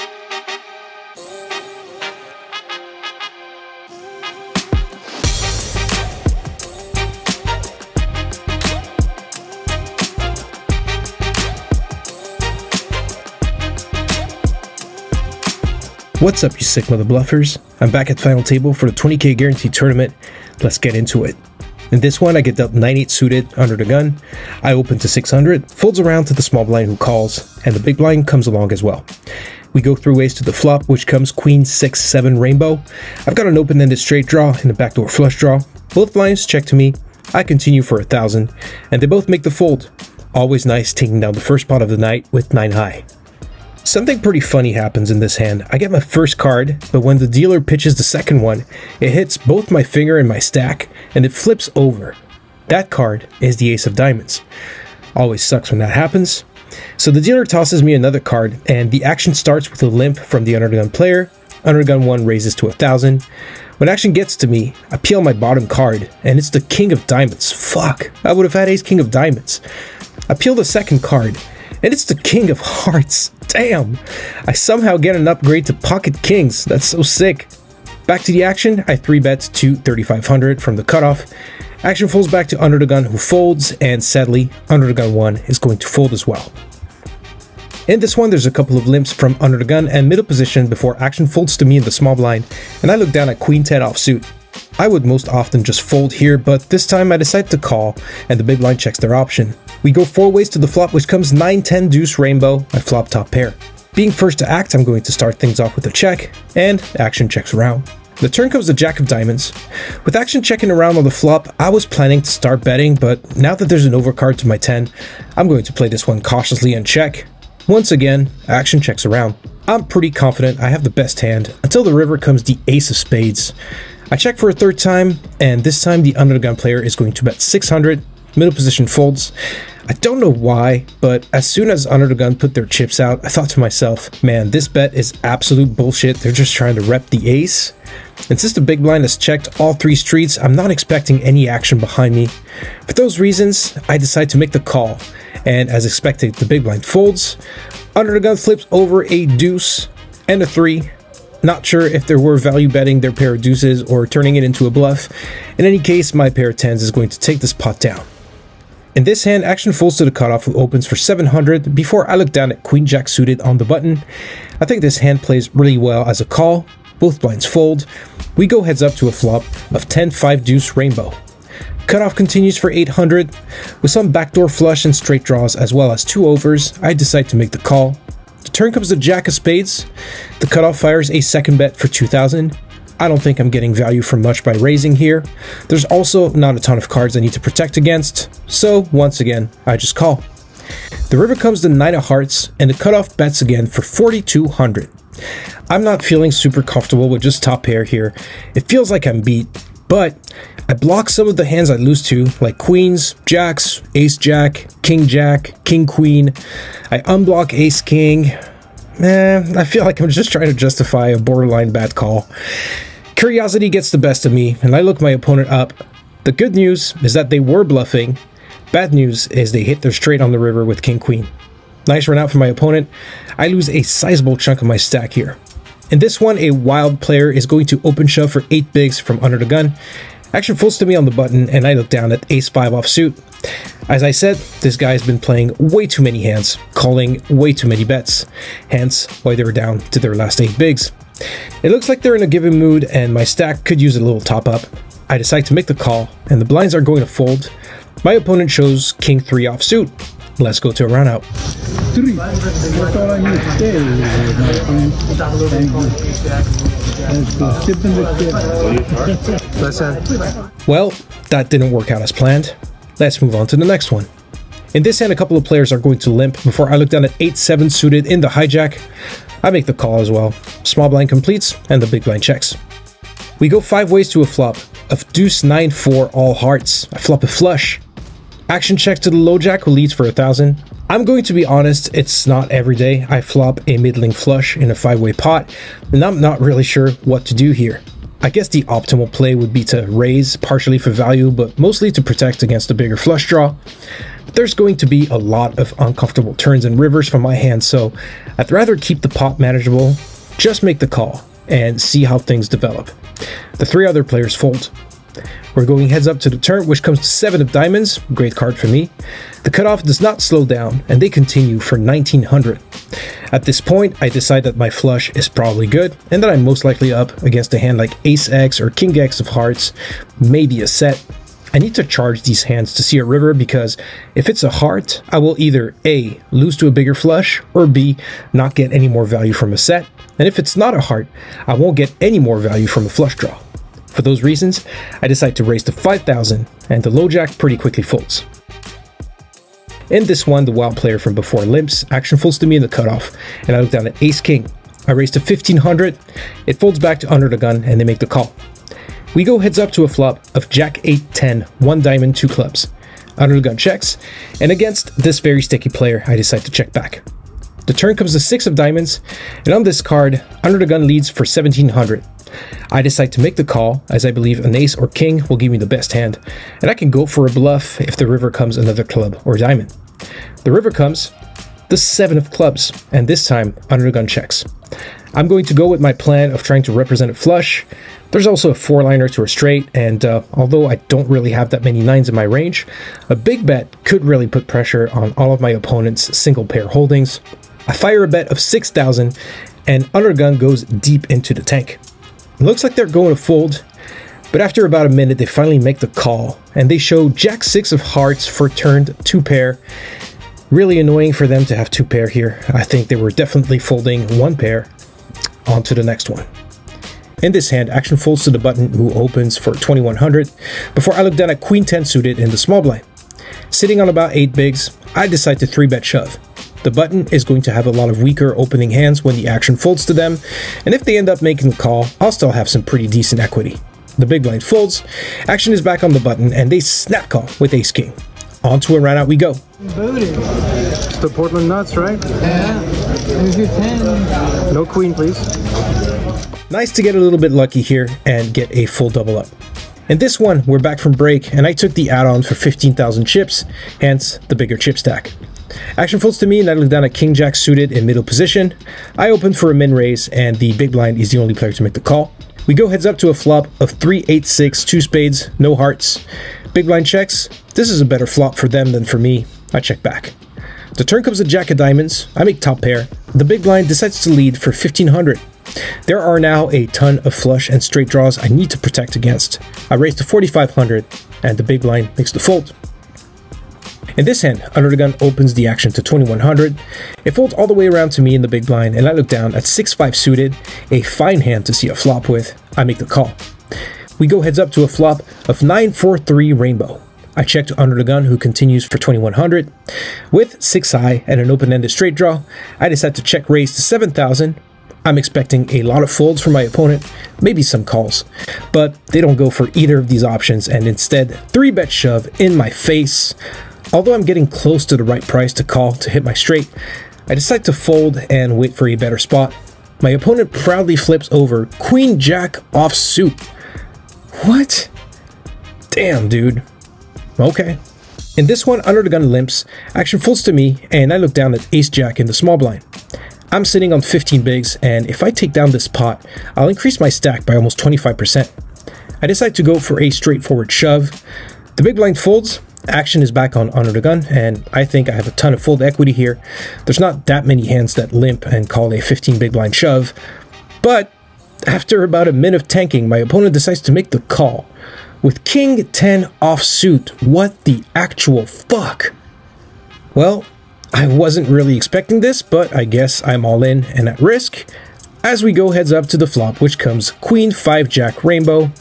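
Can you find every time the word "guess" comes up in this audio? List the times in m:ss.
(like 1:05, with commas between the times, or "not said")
4:48, 9:12.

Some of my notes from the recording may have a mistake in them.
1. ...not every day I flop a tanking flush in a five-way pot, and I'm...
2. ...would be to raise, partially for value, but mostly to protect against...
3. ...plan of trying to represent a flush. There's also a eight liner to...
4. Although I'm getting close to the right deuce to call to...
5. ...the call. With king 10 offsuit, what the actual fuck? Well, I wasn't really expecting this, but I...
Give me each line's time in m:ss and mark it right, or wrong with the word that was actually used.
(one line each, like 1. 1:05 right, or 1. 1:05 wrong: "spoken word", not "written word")
1. 4:42 wrong: "middling", not "tanking"
2. 4:49 right
3. 6:15 wrong: "four", not "eight"
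4. 8:23 wrong: "price", not "deuce"
5. 9:03 right.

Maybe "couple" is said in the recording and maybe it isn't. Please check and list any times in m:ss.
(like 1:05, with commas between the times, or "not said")
1:28, 4:25.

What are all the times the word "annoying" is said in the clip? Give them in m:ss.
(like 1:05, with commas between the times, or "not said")
6:40.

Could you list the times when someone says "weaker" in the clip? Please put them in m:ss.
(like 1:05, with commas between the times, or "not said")
6:58.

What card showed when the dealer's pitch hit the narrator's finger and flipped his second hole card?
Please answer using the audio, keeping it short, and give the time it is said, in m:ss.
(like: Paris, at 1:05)
Ace of Diamonds, at 0:53.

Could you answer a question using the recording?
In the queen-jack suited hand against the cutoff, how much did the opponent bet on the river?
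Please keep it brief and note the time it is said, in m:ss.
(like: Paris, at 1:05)
4,200, at 3:13.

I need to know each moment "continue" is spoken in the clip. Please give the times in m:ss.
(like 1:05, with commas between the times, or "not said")
0:37, 2:52, 5:11, 8:08.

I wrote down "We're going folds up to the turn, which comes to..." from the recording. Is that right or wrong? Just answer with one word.
wrong.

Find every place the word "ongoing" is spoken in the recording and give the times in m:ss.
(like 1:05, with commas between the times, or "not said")
not said.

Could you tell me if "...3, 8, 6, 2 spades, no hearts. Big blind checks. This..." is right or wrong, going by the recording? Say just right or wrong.
right.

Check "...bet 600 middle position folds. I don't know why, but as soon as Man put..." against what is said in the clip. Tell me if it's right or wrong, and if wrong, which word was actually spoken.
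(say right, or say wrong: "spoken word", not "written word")
wrong: "Gun", not "Man".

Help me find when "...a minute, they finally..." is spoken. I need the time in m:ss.
6:34.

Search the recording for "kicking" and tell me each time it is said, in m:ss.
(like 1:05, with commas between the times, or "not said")
not said.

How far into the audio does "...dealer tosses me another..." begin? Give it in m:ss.
0:57.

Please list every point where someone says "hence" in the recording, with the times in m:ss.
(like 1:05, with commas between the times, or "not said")
3:58, 7:23.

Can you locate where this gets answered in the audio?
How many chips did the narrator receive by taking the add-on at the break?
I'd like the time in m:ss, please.
7:22.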